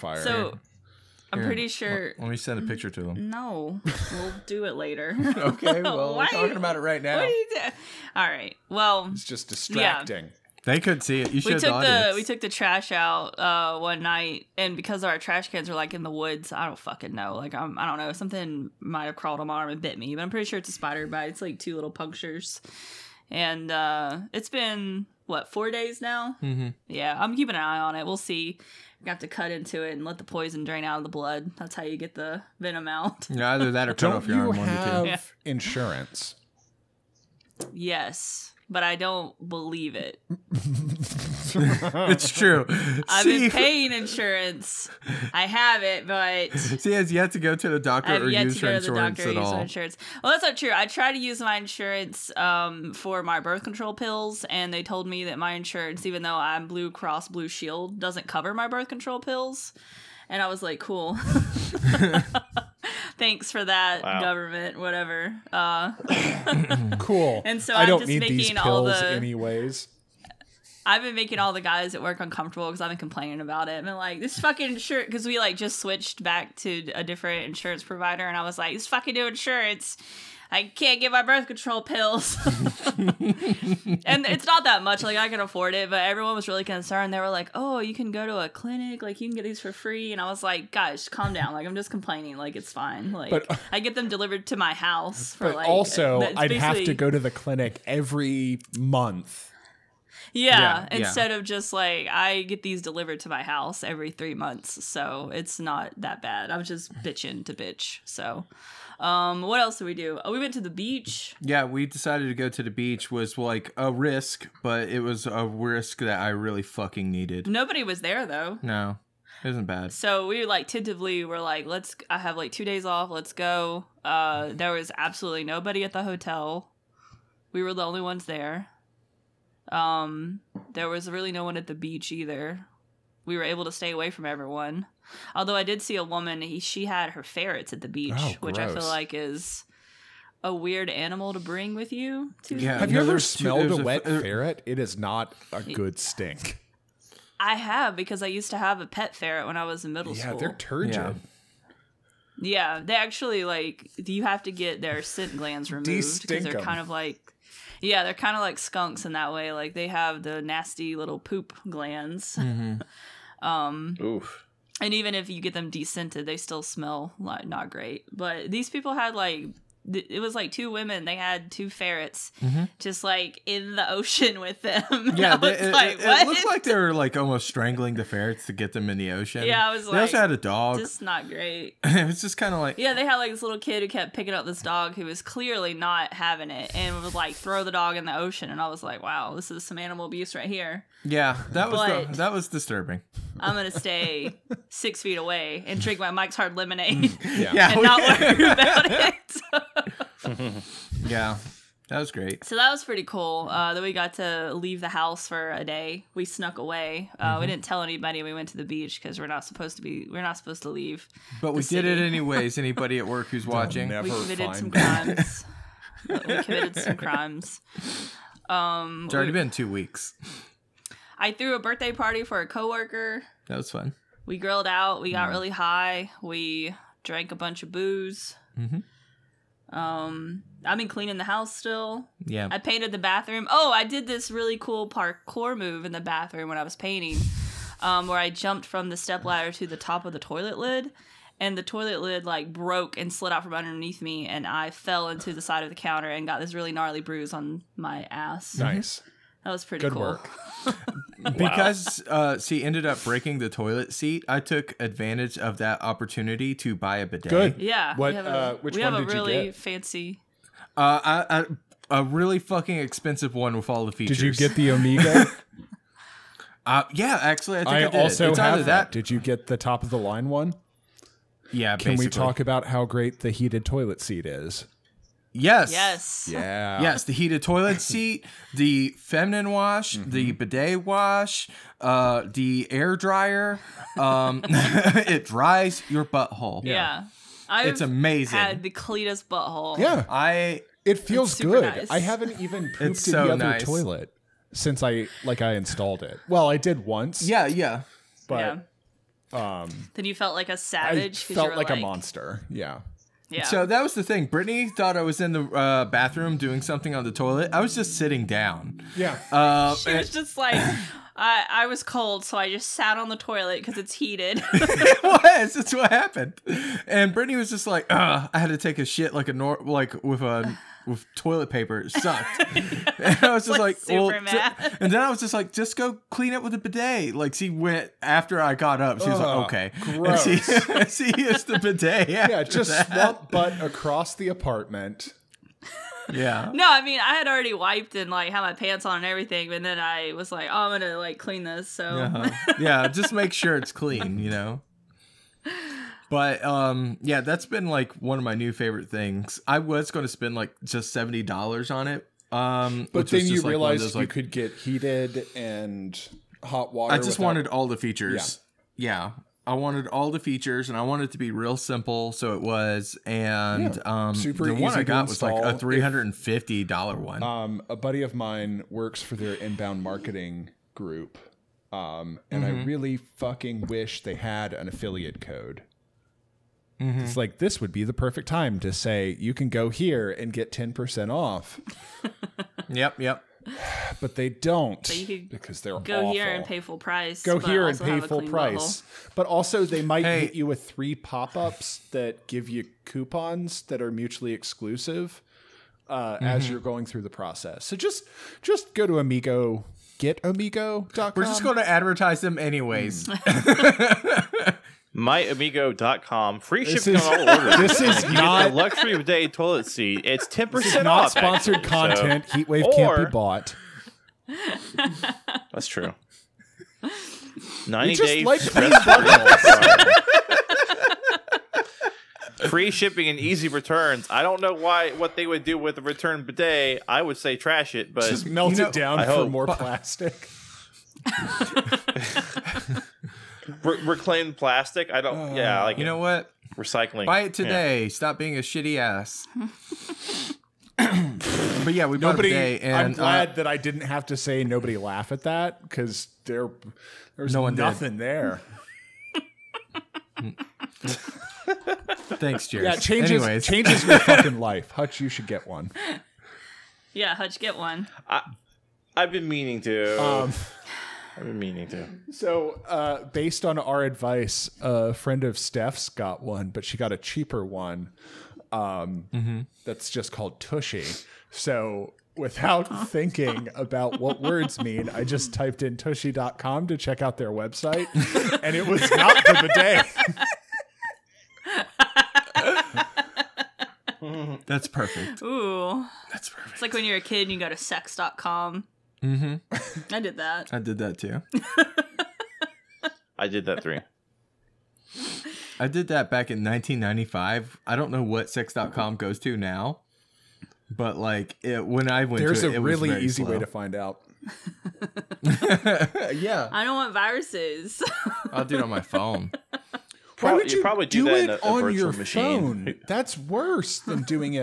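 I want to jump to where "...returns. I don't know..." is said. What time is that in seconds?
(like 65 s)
423 s.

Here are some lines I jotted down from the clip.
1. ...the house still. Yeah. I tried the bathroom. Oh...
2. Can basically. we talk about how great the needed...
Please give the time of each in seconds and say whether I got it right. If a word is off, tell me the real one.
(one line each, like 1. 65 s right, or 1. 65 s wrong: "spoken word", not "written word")
1. 231 s wrong: "painted", not "tried"
2. 271 s wrong: "heated", not "needed".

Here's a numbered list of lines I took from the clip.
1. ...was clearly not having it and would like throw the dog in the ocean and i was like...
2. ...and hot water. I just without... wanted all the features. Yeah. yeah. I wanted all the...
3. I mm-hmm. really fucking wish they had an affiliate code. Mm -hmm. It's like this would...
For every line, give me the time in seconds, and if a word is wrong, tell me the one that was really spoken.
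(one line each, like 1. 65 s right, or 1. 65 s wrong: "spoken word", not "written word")
1. 185 s right
2. 355 s right
3. 372 s right.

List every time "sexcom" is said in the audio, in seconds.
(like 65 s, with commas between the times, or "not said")
487 s, 498 s.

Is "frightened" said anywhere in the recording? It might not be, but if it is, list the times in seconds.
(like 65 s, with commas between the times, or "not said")
not said.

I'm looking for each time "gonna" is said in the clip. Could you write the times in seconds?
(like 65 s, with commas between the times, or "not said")
193 s, 340 s.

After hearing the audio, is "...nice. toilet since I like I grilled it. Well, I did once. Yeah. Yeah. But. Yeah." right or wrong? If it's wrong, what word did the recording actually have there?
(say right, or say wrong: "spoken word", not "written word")
wrong: "installed", not "grilled".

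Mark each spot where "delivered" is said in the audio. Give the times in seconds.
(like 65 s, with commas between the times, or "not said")
94 s, 102 s.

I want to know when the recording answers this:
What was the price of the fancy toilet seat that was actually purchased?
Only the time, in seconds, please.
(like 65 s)
365 s.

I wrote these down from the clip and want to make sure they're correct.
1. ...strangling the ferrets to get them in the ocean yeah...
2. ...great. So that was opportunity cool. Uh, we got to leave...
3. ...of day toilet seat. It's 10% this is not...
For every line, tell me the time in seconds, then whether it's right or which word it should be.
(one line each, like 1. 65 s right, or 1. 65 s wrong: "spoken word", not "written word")
1. 177 s right
2. 202 s wrong: "pretty", not "opportunity"
3. 408 s right.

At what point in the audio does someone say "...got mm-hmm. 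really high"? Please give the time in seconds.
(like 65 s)
225 s.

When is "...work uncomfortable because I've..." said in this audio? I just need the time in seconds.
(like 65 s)
72 s.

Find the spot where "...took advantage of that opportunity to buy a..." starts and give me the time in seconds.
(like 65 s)
254 s.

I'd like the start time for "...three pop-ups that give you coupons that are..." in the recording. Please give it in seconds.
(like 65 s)
390 s.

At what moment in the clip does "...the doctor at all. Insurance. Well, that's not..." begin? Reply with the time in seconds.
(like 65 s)
48 s.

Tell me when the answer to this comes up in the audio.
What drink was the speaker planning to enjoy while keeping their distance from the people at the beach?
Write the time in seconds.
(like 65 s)
196 s.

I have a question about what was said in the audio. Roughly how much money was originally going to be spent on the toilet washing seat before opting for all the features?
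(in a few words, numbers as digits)
$70.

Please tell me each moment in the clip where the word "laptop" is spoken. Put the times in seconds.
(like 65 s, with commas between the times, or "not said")
not said.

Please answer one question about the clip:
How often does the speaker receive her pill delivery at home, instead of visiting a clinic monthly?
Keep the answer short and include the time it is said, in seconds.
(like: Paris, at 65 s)
every 3 months, at 103 s.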